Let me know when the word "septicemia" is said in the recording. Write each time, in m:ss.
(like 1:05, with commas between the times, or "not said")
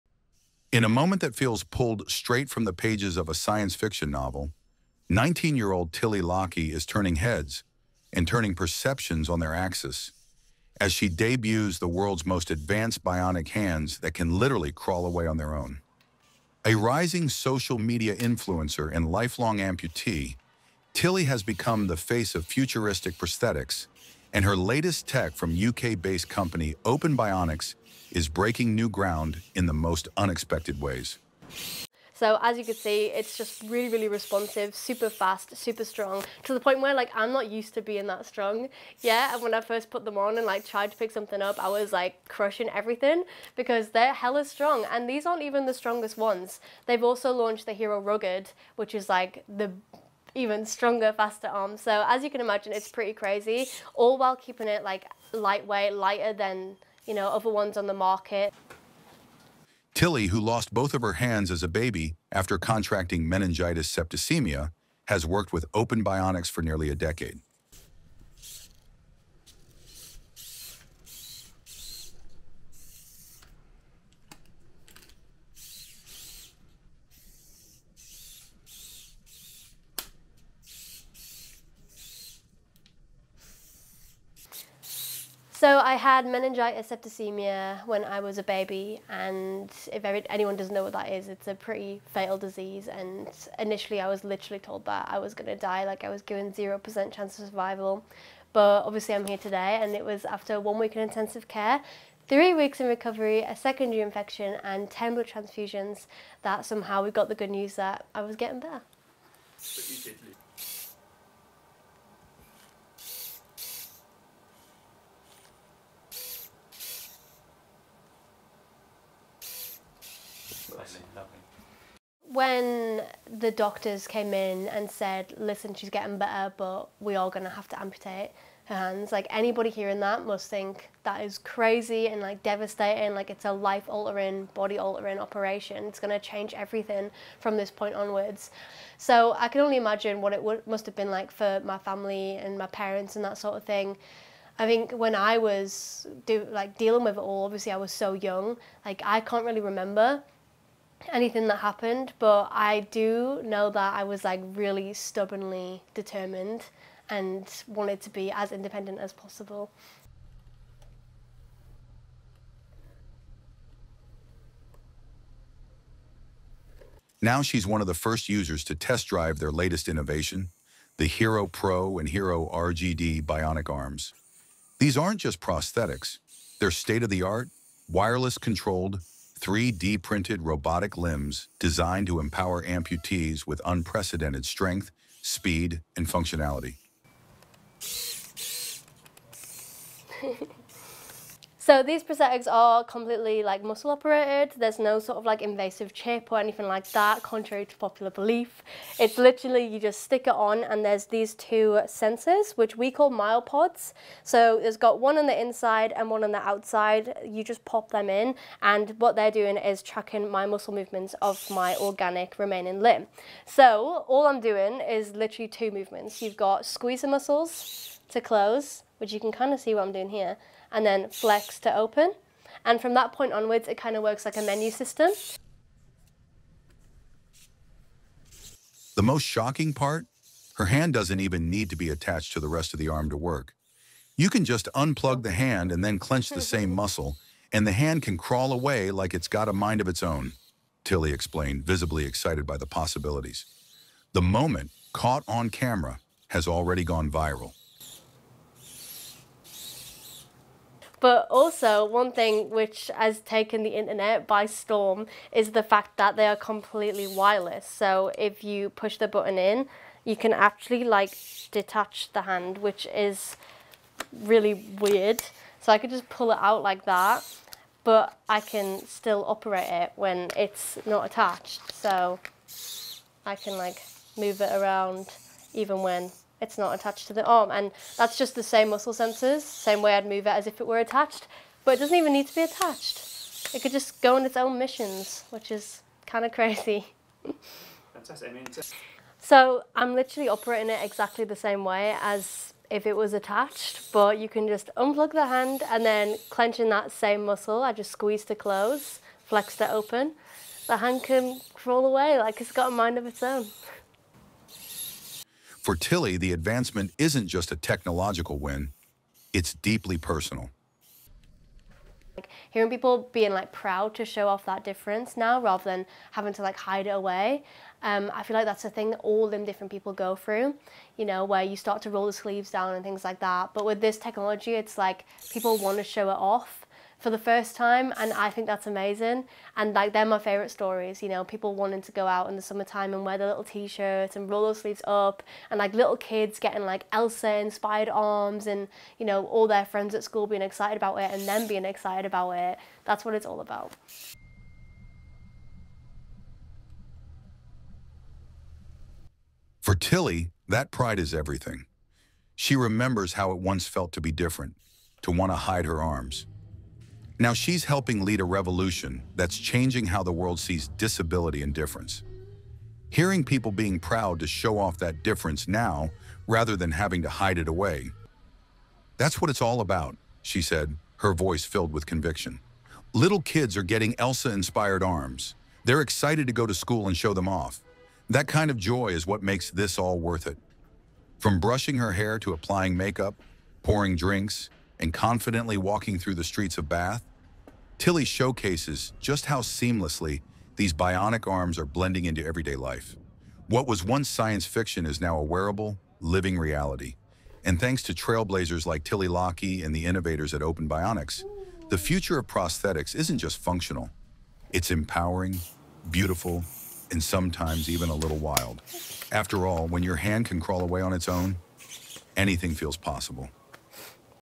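1:03, 1:26.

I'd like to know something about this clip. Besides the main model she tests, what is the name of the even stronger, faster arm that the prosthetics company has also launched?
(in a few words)
Hero Rugged.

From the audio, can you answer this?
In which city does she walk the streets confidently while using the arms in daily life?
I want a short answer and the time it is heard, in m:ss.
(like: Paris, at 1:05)
Bath, at 6:26.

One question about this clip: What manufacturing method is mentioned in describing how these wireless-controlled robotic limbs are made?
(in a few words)
3D printed.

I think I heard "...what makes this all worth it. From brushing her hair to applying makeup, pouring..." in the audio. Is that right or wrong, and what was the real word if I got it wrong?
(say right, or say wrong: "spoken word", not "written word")
right.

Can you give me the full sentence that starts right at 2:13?
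Like it's a life altering, body altering operation.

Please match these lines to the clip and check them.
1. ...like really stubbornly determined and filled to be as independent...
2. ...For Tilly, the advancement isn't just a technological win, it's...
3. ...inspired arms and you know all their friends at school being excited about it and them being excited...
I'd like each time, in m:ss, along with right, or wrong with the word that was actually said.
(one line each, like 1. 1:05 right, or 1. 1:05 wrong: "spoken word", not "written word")
1. 2:34 wrong: "wanted", not "filled"
2. 5:05 right
3. 5:37 right.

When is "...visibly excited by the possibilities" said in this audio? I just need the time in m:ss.
4:01.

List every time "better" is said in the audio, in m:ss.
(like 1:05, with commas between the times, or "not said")
1:48, 2:06.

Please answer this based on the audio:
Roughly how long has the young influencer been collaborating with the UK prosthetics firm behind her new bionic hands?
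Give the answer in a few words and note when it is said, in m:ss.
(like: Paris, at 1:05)
Nearly a decade, at 1:06.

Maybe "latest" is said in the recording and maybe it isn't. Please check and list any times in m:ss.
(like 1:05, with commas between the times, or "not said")
0:24, 2:49.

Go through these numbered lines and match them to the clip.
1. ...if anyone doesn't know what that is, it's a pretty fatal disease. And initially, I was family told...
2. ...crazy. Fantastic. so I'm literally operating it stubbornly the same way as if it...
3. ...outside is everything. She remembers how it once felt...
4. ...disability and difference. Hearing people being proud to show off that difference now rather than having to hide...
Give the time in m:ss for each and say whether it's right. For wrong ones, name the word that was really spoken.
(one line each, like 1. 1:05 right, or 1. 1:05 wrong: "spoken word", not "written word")
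1. 1:29 wrong: "literally", not "family"
2. 4:46 wrong: "exactly", not "stubbornly"
3. 5:50 wrong: "pride", not "outside"
4. 6:00 right.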